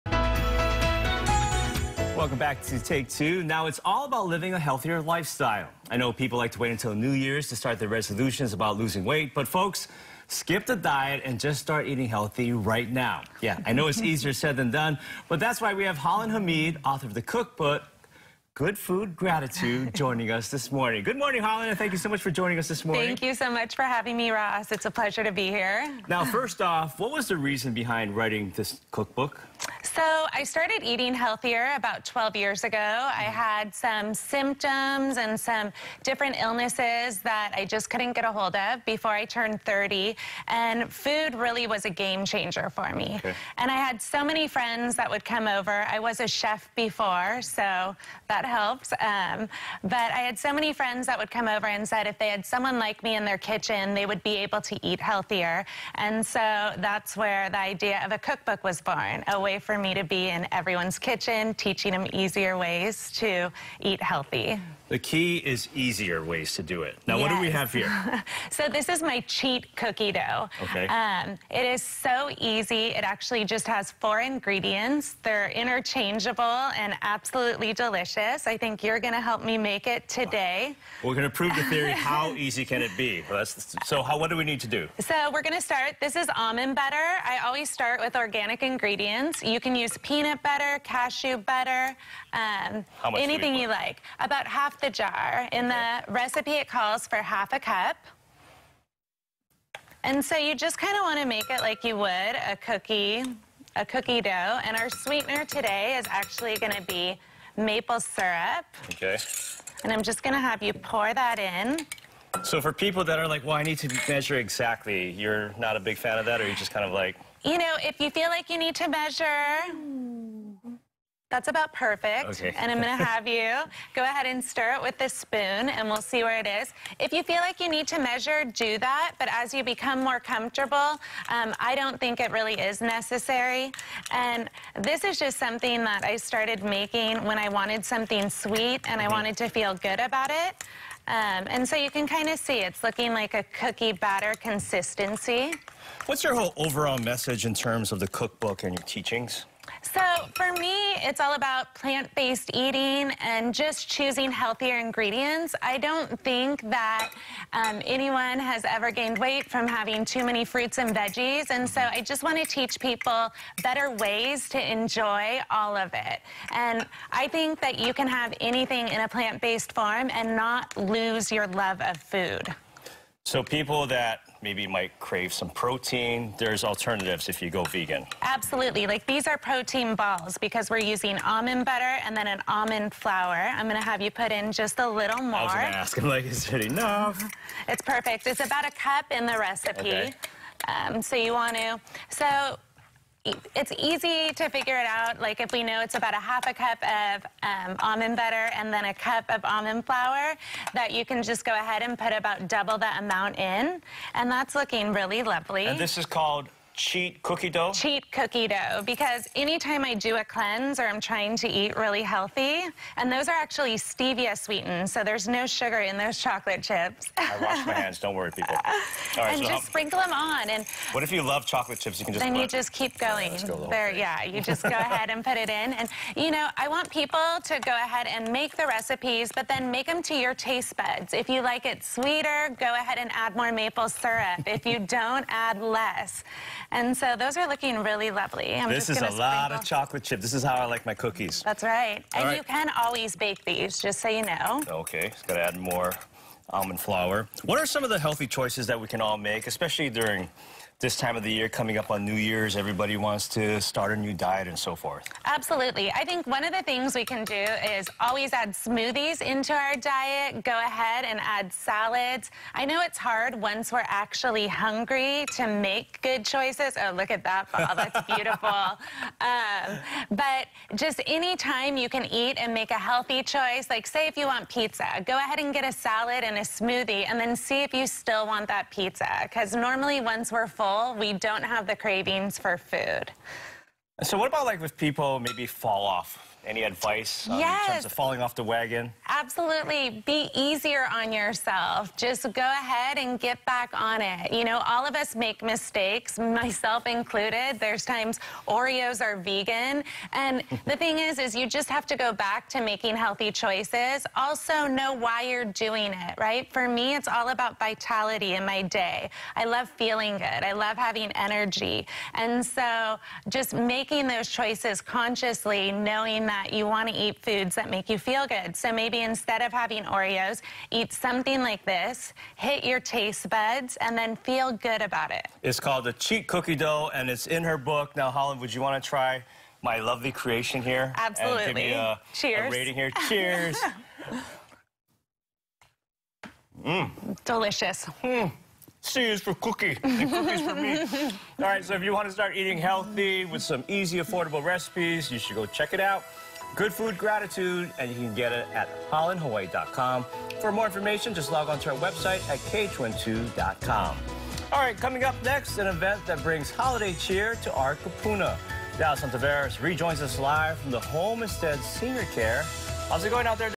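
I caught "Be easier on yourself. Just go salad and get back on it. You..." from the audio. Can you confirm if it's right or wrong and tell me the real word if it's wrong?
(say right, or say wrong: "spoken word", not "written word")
wrong: "ahead", not "salad".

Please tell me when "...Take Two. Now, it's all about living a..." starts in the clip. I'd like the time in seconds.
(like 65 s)
2 s.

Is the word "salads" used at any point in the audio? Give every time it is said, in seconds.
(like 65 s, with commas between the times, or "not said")
261 s, 275 s.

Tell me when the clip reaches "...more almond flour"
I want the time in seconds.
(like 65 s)
245 s.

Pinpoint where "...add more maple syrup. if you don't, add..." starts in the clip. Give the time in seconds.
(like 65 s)
233 s.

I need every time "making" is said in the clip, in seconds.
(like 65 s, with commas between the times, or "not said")
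136 s, 302 s, 313 s.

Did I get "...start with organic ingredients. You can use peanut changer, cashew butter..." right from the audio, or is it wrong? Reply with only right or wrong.
wrong.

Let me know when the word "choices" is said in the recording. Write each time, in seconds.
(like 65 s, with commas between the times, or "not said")
248 s, 266 s, 273 s, 303 s, 314 s.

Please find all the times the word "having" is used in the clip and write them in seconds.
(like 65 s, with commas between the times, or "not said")
23 s, 159 s, 310 s, 319 s.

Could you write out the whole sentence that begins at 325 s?
It's called the cheat cookie dough, and it's in her book.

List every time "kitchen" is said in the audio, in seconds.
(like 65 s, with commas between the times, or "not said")
53 s, 60 s.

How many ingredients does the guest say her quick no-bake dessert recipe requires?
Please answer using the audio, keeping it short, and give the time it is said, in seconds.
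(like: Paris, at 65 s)
4, at 74 s.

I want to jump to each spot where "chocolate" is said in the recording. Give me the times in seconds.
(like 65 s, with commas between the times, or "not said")
216 s, 221 s, 239 s.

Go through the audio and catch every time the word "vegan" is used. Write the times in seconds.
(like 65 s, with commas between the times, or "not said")
177 s, 299 s.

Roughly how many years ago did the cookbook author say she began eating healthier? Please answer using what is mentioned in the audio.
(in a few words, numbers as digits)
12.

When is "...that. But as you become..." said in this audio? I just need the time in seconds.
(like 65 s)
128 s.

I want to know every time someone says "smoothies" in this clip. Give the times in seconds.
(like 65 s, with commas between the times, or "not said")
258 s, 276 s.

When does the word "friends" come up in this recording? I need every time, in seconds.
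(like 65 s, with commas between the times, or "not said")
44 s, 50 s.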